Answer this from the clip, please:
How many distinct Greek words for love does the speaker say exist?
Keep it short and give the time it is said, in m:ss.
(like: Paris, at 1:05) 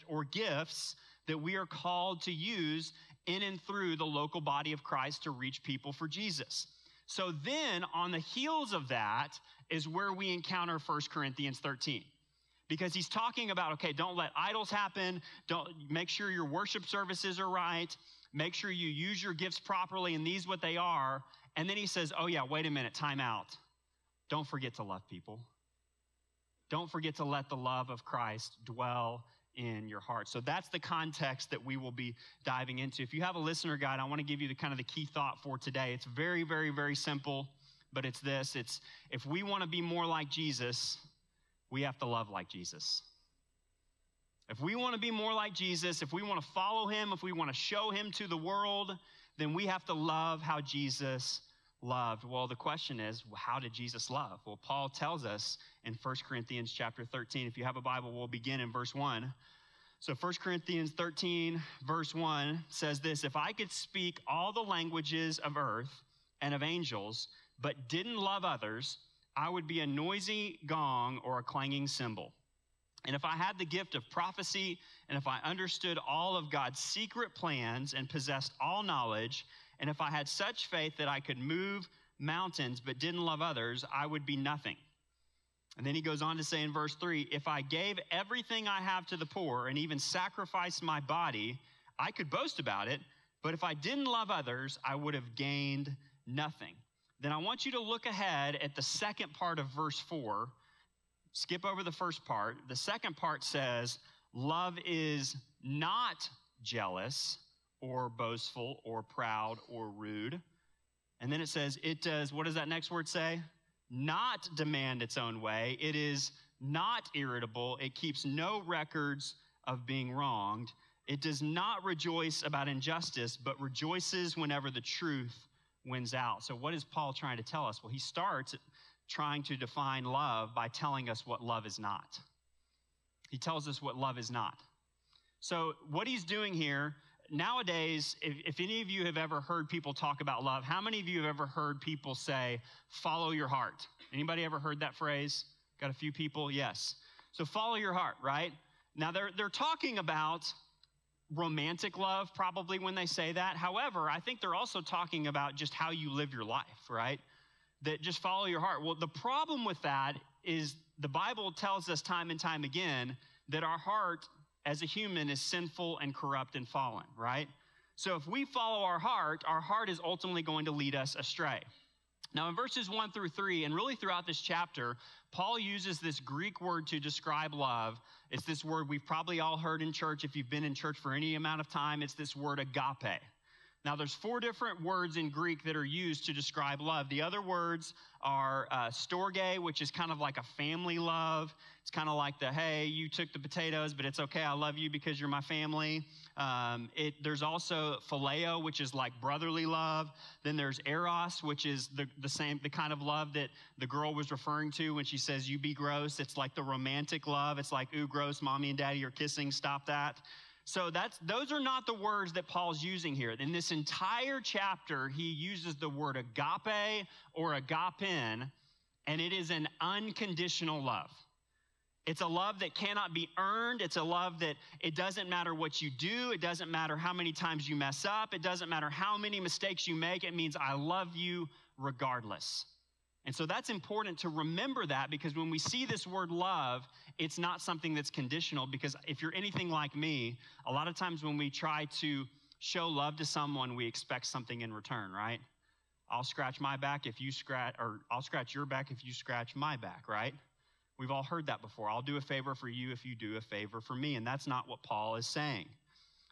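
4, at 3:04.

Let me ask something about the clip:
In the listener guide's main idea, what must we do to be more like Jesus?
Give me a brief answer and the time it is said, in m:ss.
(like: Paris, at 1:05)
Love like Jesus, at 0:42.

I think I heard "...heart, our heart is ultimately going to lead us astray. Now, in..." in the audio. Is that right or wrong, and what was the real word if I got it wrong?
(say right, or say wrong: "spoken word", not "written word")
right.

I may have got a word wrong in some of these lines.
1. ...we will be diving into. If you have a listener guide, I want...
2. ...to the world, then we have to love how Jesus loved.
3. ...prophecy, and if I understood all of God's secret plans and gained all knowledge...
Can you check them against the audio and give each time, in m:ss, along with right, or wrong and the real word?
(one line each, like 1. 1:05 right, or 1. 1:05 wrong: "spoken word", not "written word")
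1. 0:31 right
2. 0:48 right
3. 1:14 wrong: "possessed", not "gained".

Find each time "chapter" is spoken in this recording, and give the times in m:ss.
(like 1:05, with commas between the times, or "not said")
0:56, 2:54, 3:34.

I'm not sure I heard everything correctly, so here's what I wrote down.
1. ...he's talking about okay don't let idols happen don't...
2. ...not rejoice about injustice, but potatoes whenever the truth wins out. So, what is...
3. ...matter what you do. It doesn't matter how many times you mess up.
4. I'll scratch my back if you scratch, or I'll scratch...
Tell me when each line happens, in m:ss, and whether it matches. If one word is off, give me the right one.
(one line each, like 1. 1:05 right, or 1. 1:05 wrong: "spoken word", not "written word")
1. 0:12 right
2. 2:01 wrong: "rejoices", not "potatoes"
3. 3:45 right
4. 4:06 right.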